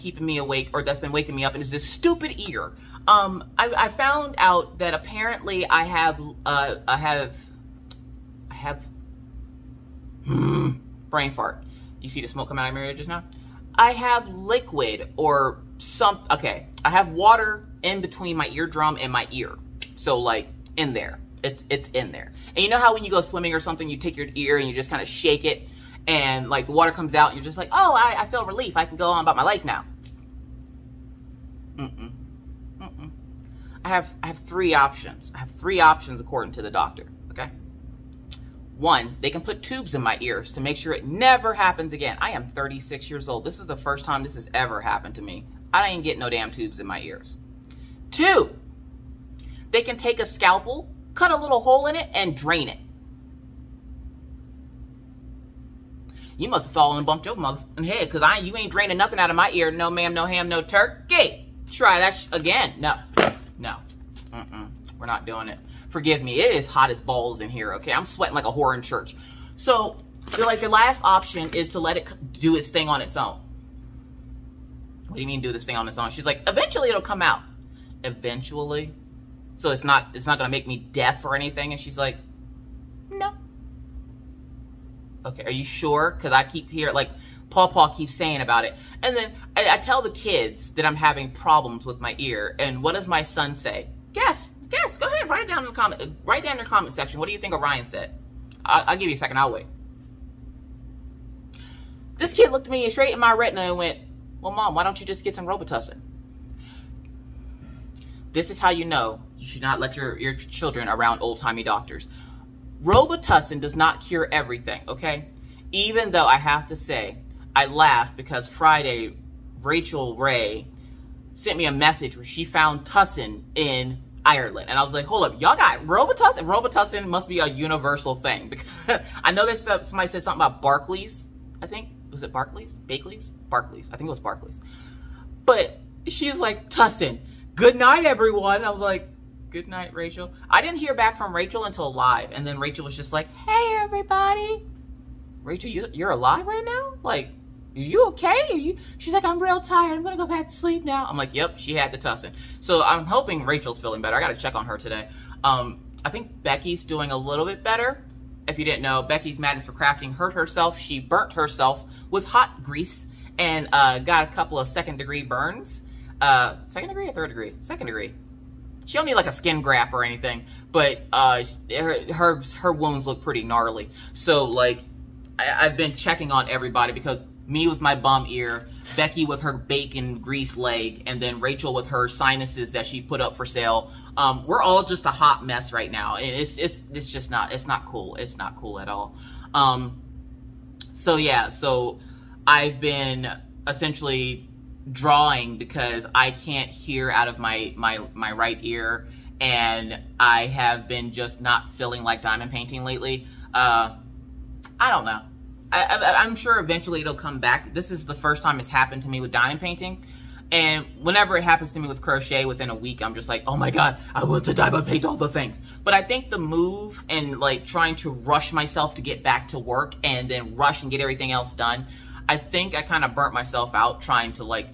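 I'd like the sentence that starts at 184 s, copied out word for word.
Um, we're all just a hot mess right now.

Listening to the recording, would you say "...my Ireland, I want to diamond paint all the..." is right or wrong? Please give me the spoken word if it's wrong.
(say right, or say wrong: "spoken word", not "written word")
wrong: "God", not "Ireland".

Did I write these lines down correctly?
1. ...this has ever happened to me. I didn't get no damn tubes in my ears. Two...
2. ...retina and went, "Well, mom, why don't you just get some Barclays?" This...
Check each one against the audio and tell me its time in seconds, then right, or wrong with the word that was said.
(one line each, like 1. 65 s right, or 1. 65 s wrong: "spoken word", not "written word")
1. 44 s right
2. 103 s wrong: "Robitussin", not "Barclays".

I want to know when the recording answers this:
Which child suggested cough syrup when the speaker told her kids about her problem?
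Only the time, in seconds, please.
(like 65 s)
97 s.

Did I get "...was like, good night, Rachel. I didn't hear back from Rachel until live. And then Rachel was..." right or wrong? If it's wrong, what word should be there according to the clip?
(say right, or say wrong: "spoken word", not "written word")
right.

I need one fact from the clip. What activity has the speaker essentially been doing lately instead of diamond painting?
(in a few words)
Drawing.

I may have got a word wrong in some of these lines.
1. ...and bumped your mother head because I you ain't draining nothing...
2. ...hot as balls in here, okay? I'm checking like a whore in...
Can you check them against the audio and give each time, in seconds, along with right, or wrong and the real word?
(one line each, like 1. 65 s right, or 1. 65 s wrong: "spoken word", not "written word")
1. 56 s right
2. 66 s wrong: "sweating", not "checking".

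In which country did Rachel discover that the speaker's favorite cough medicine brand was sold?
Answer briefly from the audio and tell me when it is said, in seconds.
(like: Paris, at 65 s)
Ireland, at 124 s.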